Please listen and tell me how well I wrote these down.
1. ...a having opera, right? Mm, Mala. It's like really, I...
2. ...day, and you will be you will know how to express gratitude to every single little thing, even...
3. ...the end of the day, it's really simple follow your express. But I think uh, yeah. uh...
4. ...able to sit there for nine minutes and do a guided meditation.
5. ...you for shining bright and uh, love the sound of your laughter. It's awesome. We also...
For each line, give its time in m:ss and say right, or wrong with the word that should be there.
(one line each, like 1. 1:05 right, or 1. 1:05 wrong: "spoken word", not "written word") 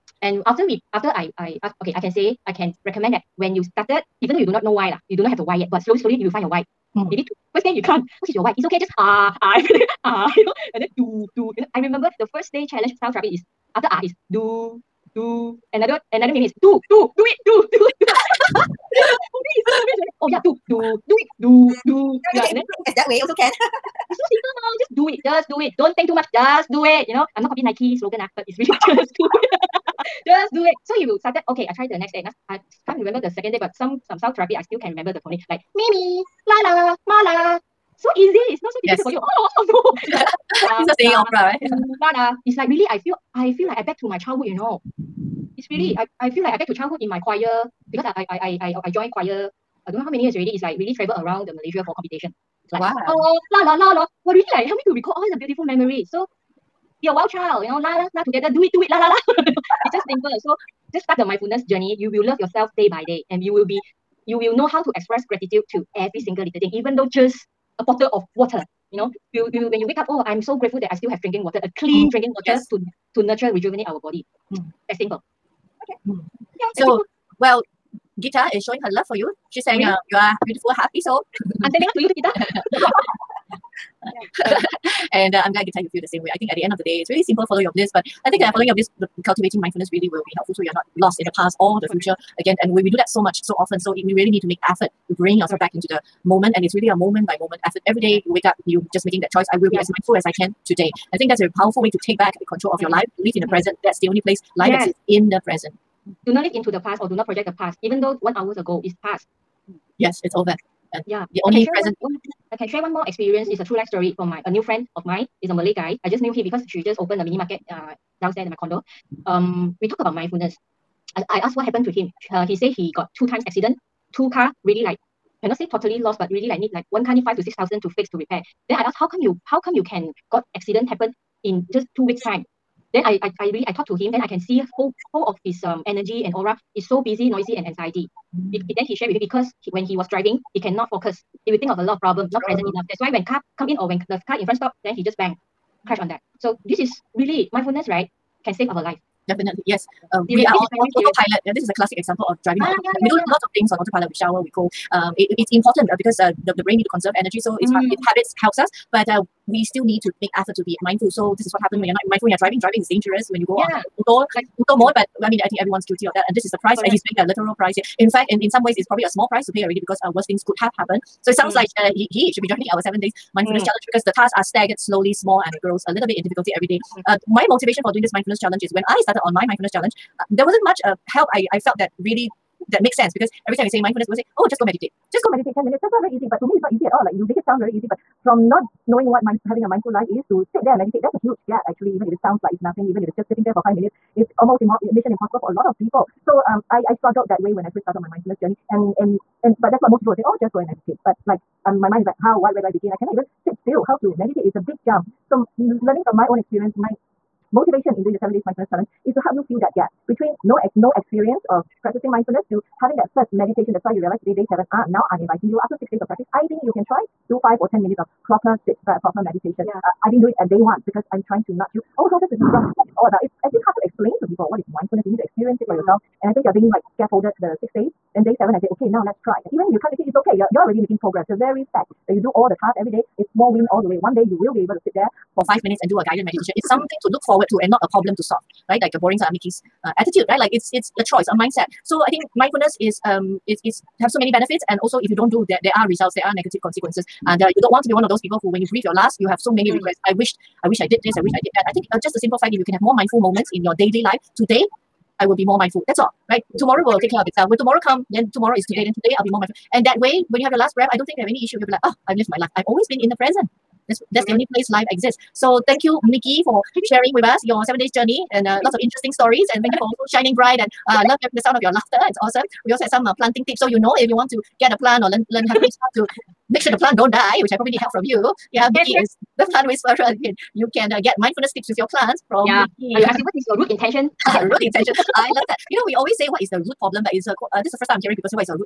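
1. 0:40 wrong: "singing", not "having"
2. 1:03 right
3. 1:26 wrong: "bliss", not "express"
4. 3:54 wrong: "five", not "nine"
5. 4:29 right.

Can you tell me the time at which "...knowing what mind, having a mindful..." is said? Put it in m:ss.
3:08.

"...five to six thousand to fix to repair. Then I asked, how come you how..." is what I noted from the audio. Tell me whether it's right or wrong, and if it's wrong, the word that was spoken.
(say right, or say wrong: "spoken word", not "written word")
right.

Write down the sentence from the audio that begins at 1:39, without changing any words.
as mindful as i can today.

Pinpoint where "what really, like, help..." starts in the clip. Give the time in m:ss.
0:54.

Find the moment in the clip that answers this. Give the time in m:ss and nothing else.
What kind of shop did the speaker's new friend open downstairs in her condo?
1:57.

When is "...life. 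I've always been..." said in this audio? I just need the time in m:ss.
4:22.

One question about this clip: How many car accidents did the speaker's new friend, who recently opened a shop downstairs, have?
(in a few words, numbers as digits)
2.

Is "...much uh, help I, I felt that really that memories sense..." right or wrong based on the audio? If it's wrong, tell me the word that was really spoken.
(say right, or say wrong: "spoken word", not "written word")
wrong: "makes", not "memories".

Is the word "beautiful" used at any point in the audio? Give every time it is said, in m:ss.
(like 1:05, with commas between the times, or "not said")
0:55, 1:20.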